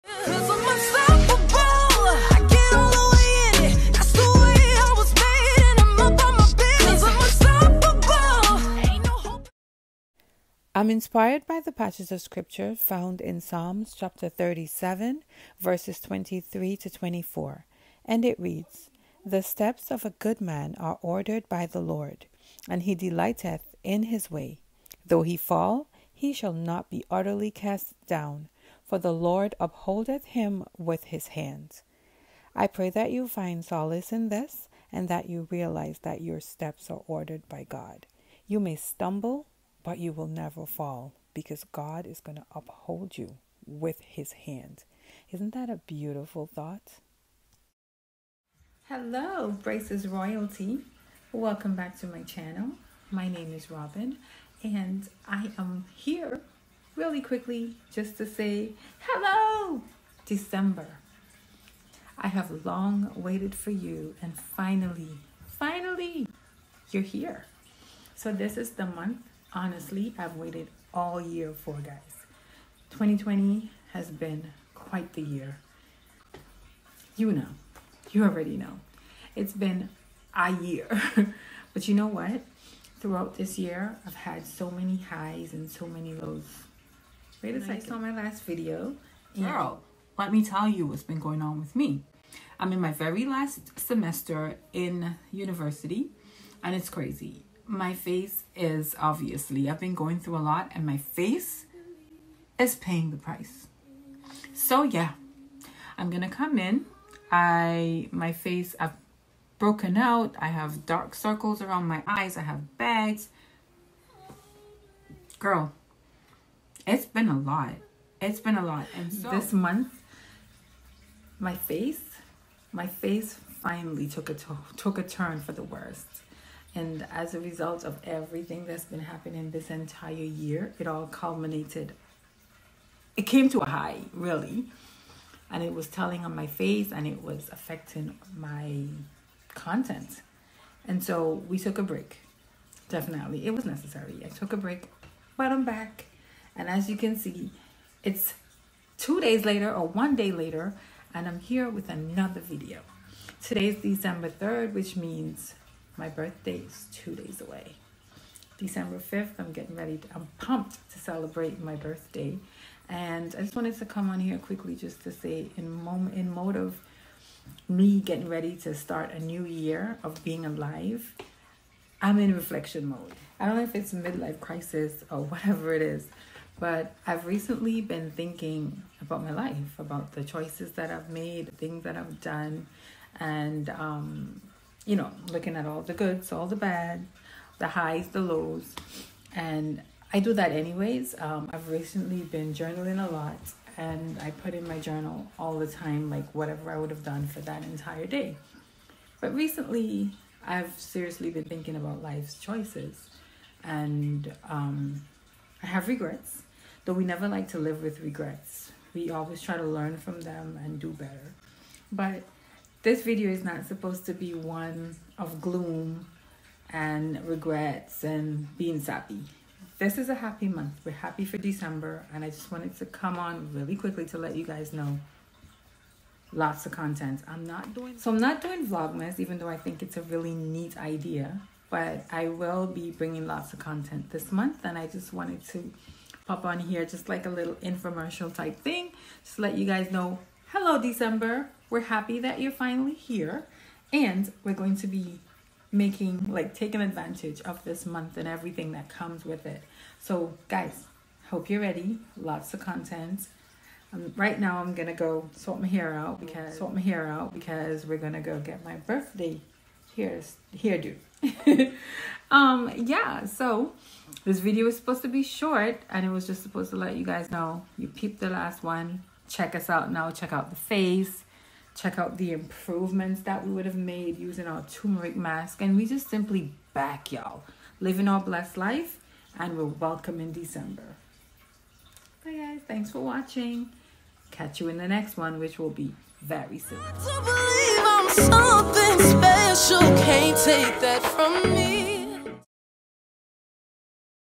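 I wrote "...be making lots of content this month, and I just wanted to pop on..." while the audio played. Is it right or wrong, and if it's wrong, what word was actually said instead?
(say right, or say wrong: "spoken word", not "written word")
wrong: "bringing", not "making".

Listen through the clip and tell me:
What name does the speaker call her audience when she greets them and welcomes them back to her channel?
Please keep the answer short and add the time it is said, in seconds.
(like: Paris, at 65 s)
Braces Royalty, at 49 s.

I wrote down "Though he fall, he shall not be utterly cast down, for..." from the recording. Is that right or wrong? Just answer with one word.
right.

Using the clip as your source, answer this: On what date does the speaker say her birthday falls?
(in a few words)
December 5th.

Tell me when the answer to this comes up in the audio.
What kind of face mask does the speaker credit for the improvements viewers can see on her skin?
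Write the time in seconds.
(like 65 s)
274 s.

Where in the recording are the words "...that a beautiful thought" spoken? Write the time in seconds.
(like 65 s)
45 s.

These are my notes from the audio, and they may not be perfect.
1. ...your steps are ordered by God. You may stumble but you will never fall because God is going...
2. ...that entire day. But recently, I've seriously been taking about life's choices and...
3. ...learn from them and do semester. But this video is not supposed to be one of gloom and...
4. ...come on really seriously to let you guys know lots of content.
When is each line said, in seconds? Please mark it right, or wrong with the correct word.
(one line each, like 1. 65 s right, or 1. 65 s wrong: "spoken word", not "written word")
1. 36 s right
2. 197 s wrong: "thinking", not "taking"
3. 209 s wrong: "better", not "semester"
4. 222 s wrong: "quickly", not "seriously".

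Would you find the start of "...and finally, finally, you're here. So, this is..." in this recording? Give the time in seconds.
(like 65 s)
64 s.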